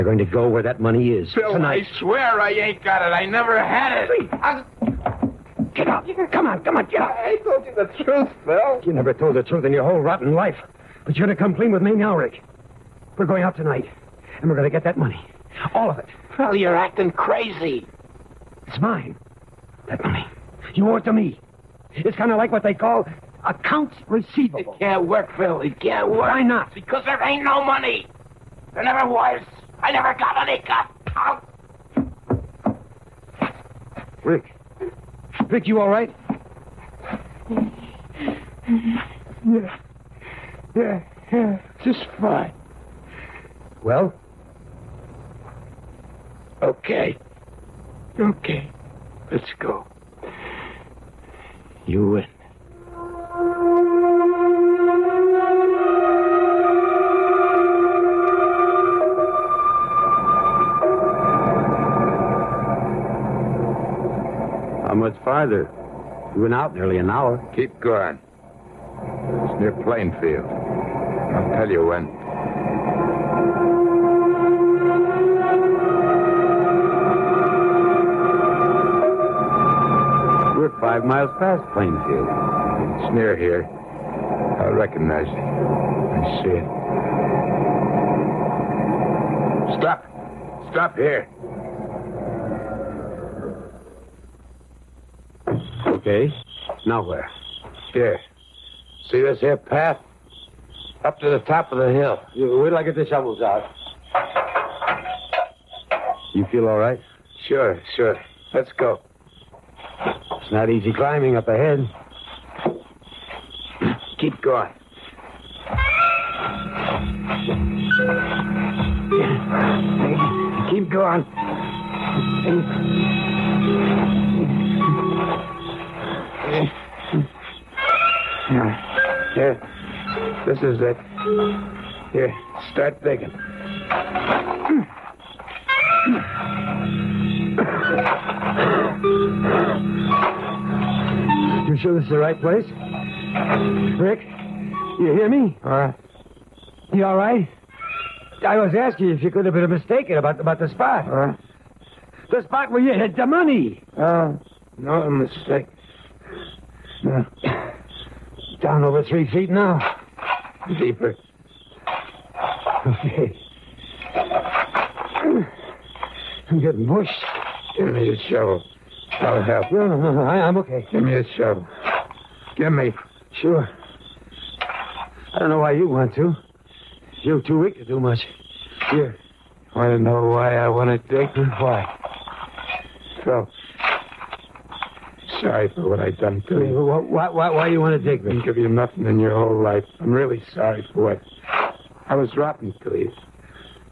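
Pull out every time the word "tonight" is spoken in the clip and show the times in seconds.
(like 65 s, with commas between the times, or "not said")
1 s, 13 s.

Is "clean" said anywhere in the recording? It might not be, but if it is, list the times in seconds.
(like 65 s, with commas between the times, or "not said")
11 s.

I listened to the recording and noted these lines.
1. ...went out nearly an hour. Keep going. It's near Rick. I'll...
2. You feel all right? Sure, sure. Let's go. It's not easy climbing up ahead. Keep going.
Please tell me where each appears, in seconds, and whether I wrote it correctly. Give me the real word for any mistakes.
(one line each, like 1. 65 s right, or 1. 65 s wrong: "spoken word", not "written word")
1. 66 s wrong: "Plainfield", not "Rick"
2. 106 s right.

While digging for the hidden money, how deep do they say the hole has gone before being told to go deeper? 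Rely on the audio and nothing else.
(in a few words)
over 3 feet.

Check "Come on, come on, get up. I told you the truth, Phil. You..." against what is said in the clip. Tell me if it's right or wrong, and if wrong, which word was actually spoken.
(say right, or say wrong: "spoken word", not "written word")
right.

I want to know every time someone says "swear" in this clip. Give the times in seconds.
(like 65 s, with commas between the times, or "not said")
1 s.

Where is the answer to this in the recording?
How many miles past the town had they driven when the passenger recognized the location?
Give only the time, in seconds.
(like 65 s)
80 s.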